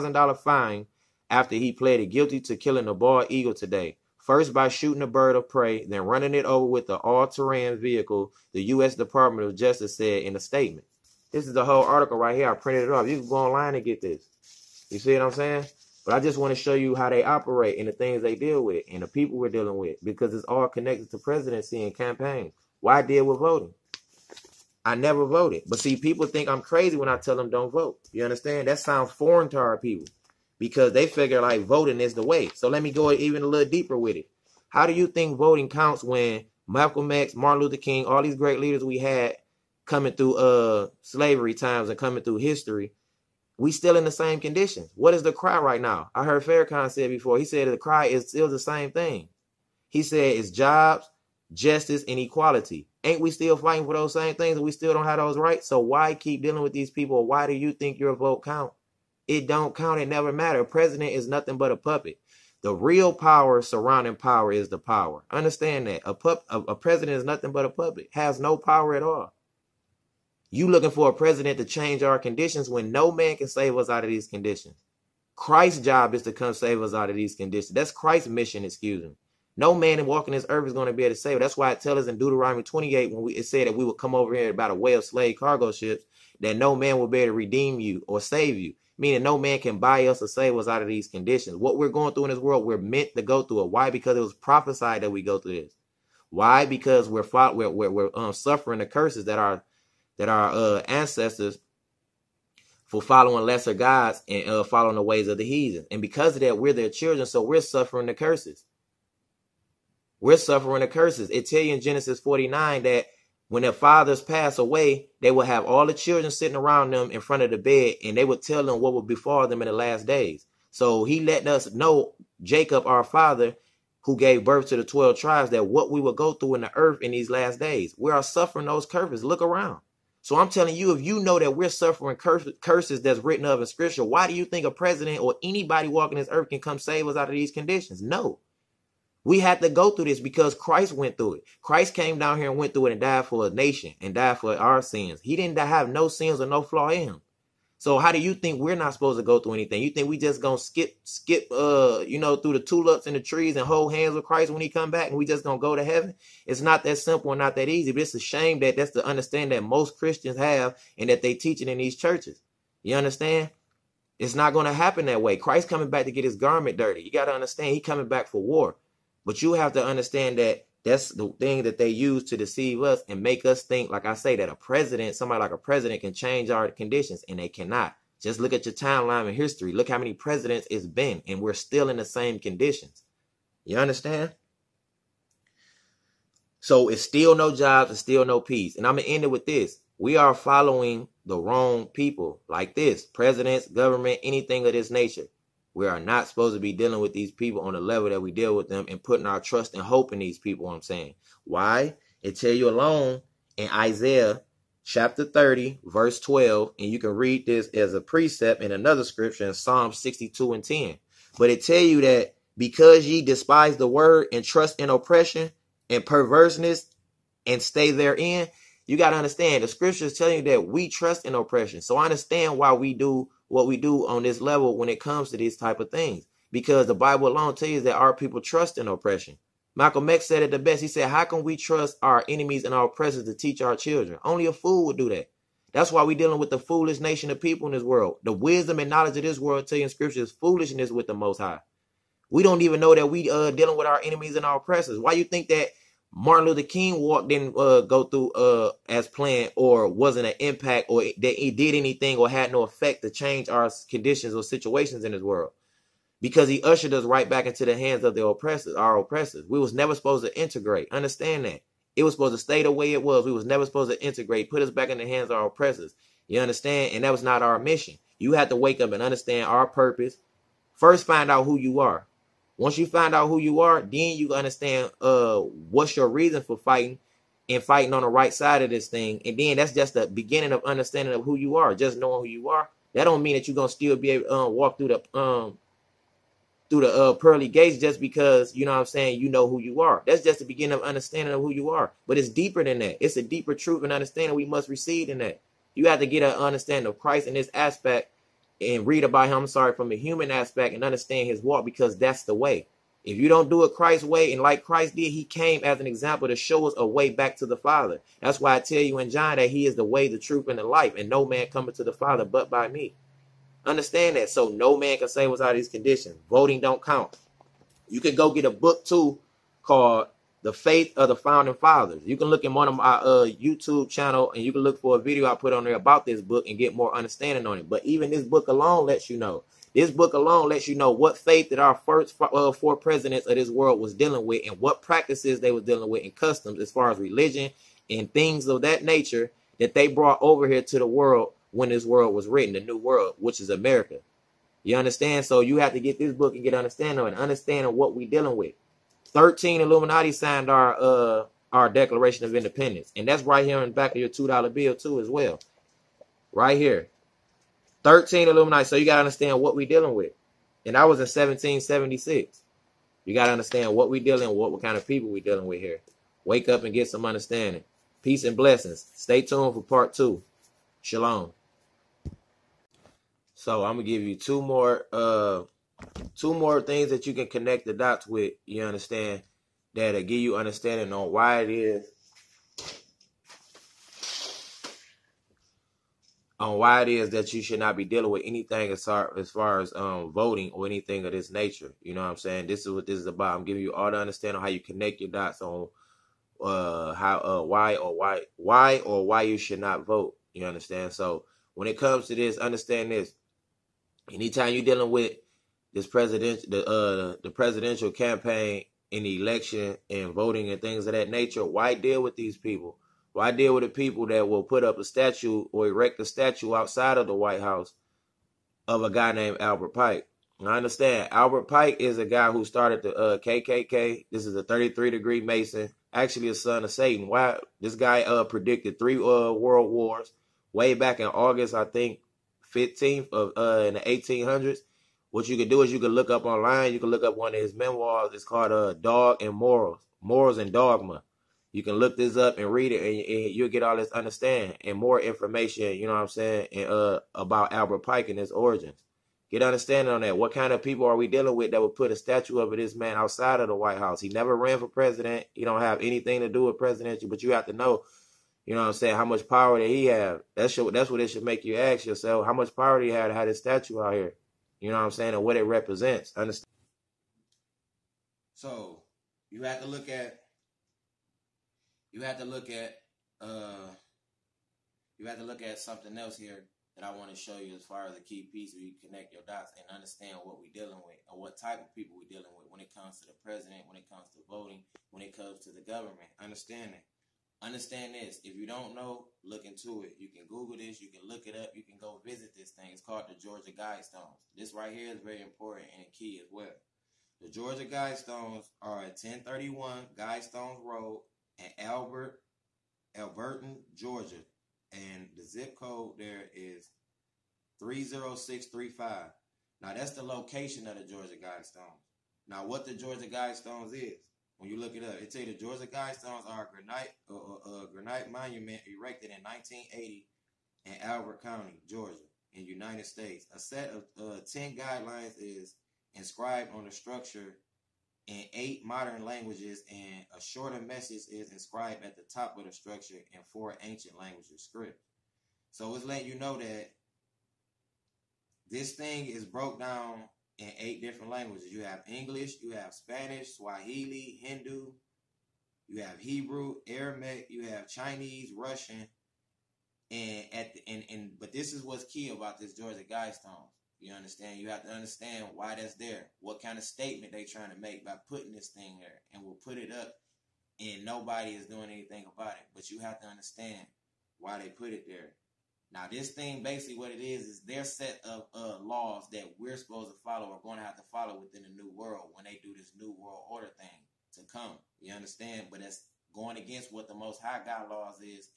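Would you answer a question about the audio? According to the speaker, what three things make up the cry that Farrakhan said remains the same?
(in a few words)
jobs, justice, and equality.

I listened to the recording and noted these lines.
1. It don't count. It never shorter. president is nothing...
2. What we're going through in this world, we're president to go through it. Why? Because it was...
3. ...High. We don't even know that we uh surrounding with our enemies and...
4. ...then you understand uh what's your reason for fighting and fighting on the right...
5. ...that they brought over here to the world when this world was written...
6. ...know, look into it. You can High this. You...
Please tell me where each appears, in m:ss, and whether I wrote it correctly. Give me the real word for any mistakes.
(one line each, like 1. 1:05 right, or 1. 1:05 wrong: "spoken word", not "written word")
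1. 0:59 wrong: "matter", not "shorter"
2. 1:31 wrong: "meant", not "president"
3. 4:01 wrong: "dealing", not "surrounding"
4. 4:33 right
5. 5:39 right
6. 8:08 wrong: "Google", not "High".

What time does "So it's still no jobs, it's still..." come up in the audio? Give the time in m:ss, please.
3:06.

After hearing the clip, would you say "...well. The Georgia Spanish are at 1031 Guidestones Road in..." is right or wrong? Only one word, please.
wrong.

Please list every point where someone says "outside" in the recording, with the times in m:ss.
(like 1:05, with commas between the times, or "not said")
6:56, 7:32.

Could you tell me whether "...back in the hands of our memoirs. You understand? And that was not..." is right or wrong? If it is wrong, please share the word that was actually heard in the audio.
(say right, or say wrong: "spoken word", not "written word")
wrong: "oppressors", not "memoirs".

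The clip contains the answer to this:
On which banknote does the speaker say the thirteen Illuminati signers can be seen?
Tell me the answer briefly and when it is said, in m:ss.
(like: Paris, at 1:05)
$2 bill, at 5:54.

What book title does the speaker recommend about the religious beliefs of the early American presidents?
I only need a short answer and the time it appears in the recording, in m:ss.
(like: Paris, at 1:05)
The Faith of the Founding Fathers, at 5:20.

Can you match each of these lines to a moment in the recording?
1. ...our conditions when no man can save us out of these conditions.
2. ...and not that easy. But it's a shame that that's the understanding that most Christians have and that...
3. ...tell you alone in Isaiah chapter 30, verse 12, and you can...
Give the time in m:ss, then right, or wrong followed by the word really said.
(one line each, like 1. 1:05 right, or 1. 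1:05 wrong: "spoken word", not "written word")
1. 1:12 right
2. 2:37 right
3. 3:22 right.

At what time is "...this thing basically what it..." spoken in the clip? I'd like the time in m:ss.
9:25.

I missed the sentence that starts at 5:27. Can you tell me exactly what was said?
But even this book alone lets you know.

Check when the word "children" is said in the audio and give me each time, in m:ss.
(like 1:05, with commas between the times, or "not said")
1:46, 1:55, 3:53.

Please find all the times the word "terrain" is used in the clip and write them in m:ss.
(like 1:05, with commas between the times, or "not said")
0:06.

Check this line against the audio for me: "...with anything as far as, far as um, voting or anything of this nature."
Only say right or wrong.
right.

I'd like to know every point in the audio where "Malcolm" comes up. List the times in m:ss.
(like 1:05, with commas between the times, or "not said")
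0:36, 3:49.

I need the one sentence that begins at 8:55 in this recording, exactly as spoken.
So it's letting you know that this thing is broke down in eight different languages.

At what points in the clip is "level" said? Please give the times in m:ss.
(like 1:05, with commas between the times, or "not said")
3:17, 3:44.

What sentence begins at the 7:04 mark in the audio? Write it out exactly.
This is a 33 degree Mason, actually a son of Satan.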